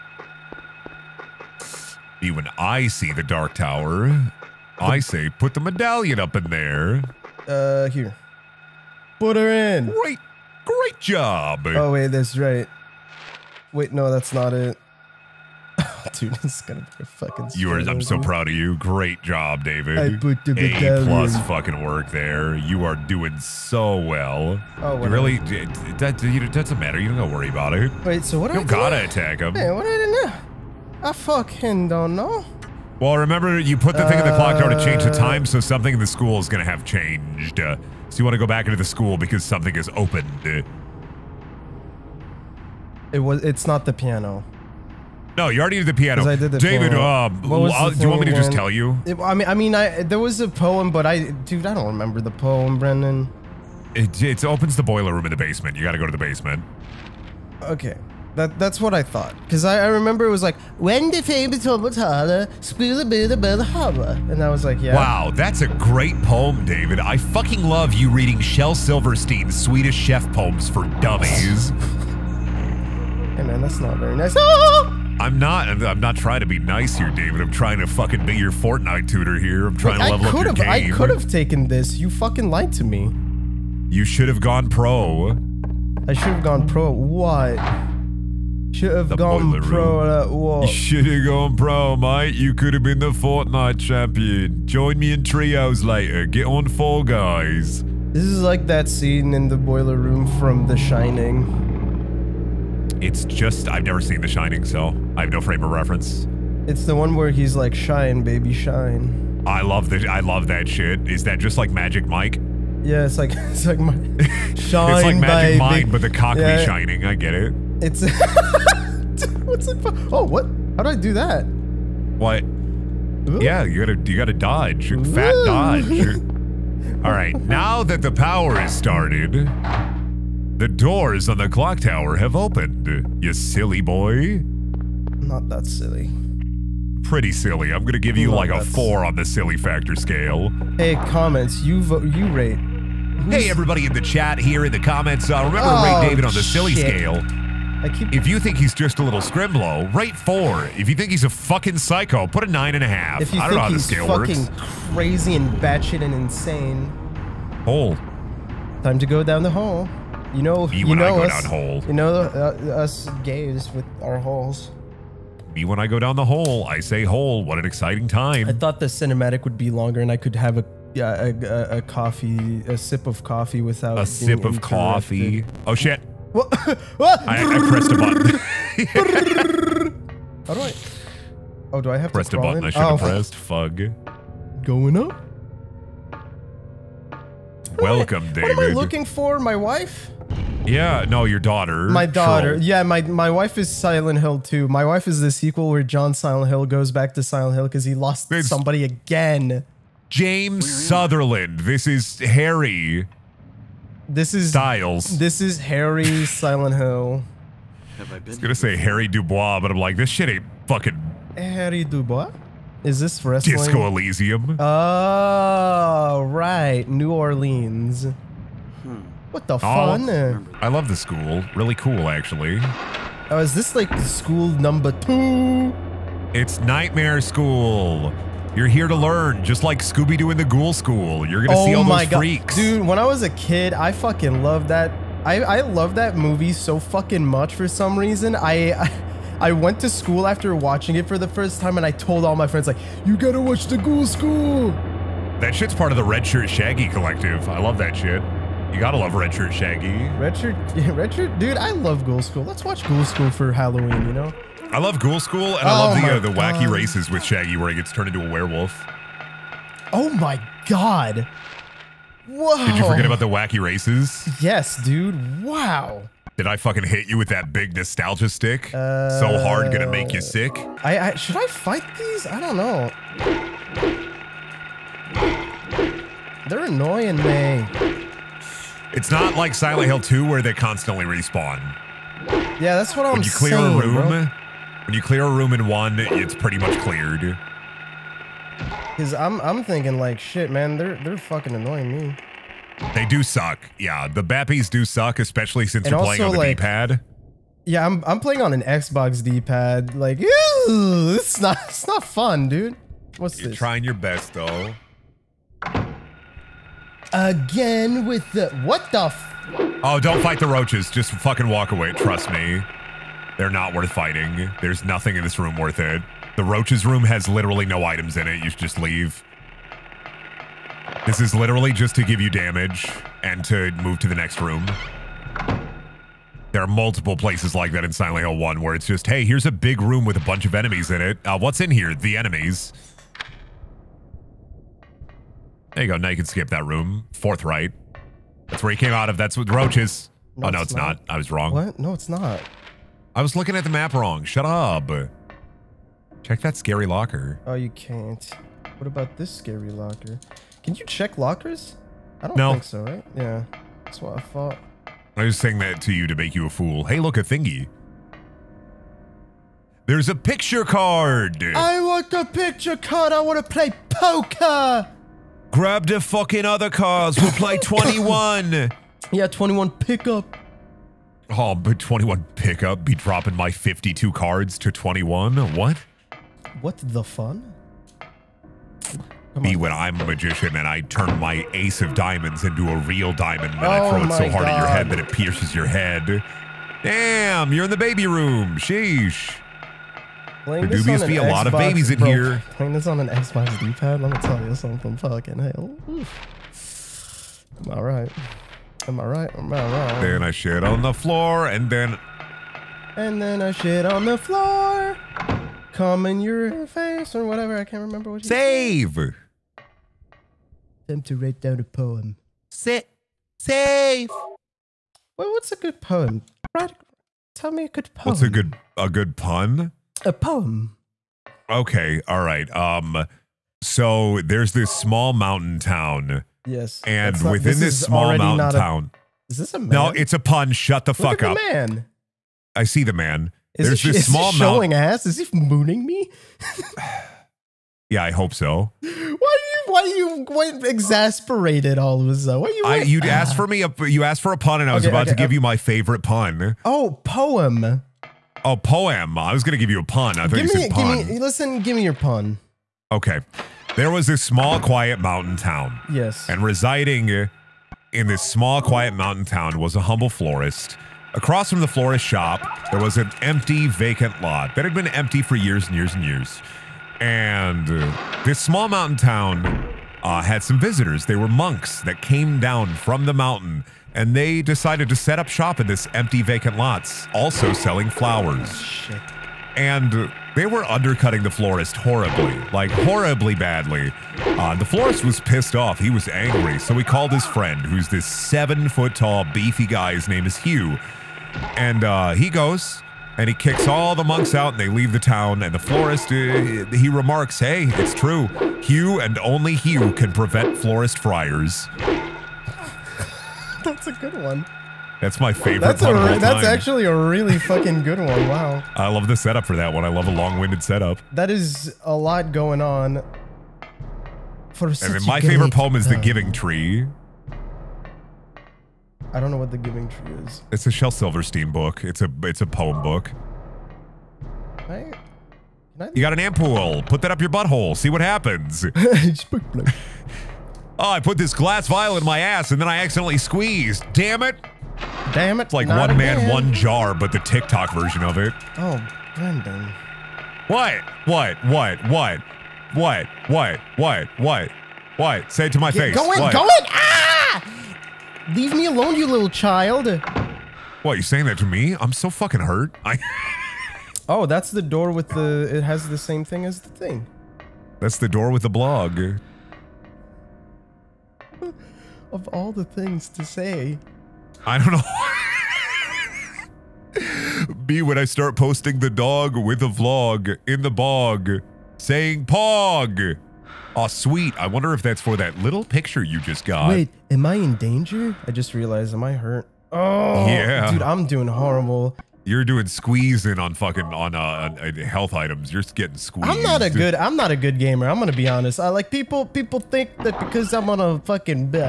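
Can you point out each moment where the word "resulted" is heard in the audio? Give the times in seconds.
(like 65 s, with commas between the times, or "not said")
not said.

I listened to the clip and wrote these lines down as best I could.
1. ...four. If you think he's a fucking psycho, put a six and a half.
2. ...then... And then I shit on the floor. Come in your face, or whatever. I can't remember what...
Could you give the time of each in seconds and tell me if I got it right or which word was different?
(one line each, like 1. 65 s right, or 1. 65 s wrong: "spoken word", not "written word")
1. 150 s wrong: "nine", not "six"
2. 401 s right.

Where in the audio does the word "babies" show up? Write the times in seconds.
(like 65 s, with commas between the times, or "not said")
391 s.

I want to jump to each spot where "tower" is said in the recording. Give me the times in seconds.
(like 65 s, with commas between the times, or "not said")
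3 s, 34 s, 131 s.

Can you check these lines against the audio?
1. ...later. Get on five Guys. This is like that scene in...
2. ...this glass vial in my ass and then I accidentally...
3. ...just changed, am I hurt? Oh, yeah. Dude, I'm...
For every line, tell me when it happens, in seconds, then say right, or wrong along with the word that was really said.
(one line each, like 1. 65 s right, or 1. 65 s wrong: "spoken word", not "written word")
1. 95 s wrong: "four", not "five"
2. 531 s right
3. 578 s wrong: "realized", not "changed".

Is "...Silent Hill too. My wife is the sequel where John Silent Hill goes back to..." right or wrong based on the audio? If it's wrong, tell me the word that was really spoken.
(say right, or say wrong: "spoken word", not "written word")
right.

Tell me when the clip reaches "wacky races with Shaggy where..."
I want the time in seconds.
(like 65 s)
256 s.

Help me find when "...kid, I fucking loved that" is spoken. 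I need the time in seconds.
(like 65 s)
233 s.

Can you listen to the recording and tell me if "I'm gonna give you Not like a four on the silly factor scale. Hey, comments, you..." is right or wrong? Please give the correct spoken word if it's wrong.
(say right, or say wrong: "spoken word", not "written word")
right.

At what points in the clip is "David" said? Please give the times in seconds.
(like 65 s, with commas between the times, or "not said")
19 s, 46 s, 66 s, 77 s, 146 s, 188 s.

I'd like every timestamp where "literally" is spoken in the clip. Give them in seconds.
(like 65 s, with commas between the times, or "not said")
317 s, 321 s.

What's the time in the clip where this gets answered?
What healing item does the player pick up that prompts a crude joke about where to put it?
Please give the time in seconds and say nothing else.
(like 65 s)
526 s.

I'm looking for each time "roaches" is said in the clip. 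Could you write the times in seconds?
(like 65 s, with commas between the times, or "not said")
310 s, 316 s, 339 s.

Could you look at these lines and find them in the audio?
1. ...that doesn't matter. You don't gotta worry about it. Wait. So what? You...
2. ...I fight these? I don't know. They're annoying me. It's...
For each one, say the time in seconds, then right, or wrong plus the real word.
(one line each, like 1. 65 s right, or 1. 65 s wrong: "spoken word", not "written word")
1. 26 s right
2. 271 s right.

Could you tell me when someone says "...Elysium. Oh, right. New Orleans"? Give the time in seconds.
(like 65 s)
213 s.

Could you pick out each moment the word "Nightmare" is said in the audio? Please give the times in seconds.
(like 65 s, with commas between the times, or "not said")
226 s.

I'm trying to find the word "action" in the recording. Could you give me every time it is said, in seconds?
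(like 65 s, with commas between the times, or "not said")
not said.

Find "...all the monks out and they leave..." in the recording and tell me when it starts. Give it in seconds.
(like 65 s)
493 s.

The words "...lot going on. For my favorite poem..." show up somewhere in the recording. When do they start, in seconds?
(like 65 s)
511 s.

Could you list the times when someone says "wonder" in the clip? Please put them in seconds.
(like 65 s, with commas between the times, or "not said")
574 s.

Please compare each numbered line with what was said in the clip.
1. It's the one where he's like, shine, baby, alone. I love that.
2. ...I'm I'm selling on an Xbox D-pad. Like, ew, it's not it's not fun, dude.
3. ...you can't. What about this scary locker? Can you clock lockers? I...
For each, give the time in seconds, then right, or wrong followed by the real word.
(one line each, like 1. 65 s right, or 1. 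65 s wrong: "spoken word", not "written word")
1. 106 s wrong: "shine", not "alone"
2. 297 s wrong: "playing", not "selling"
3. 347 s wrong: "check", not "clock".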